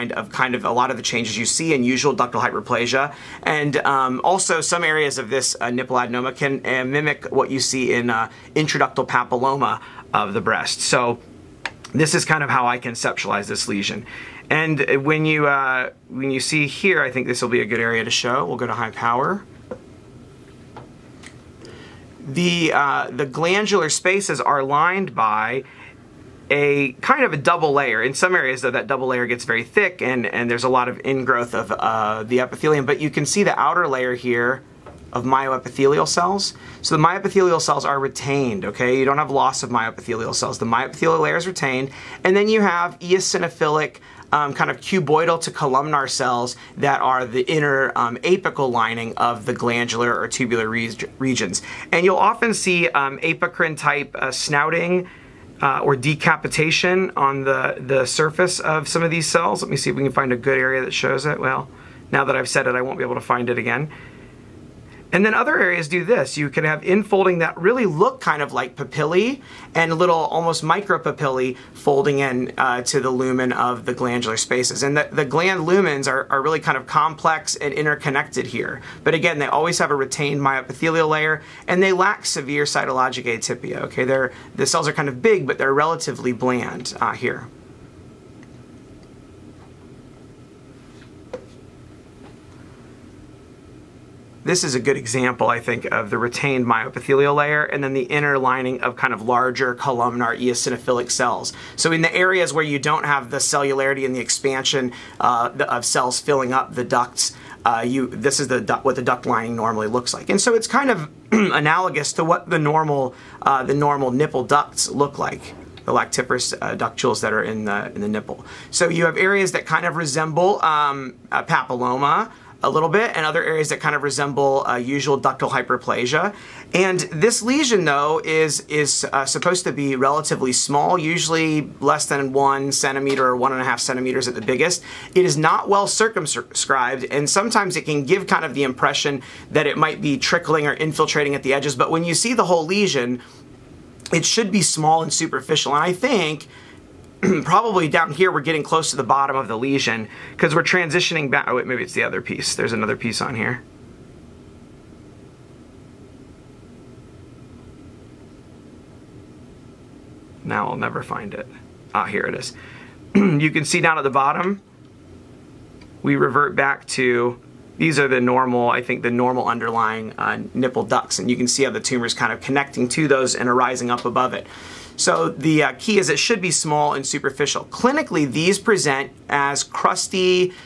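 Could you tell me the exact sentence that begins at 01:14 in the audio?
And the, the gland lumens are, are, really kind of complex and interconnected here.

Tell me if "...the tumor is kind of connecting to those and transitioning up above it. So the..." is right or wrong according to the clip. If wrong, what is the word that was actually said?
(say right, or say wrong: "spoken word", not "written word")
wrong: "arising", not "transitioning".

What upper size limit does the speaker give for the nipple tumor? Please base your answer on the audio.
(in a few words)
1.5 centimeters.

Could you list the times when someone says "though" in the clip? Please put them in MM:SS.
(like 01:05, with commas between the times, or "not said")
00:28, 02:07.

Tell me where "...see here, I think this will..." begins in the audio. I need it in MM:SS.
00:16.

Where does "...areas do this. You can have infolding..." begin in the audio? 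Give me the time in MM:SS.
01:05.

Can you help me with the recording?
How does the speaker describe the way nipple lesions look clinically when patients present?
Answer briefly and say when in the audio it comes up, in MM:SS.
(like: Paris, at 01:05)
crusty, at 02:59.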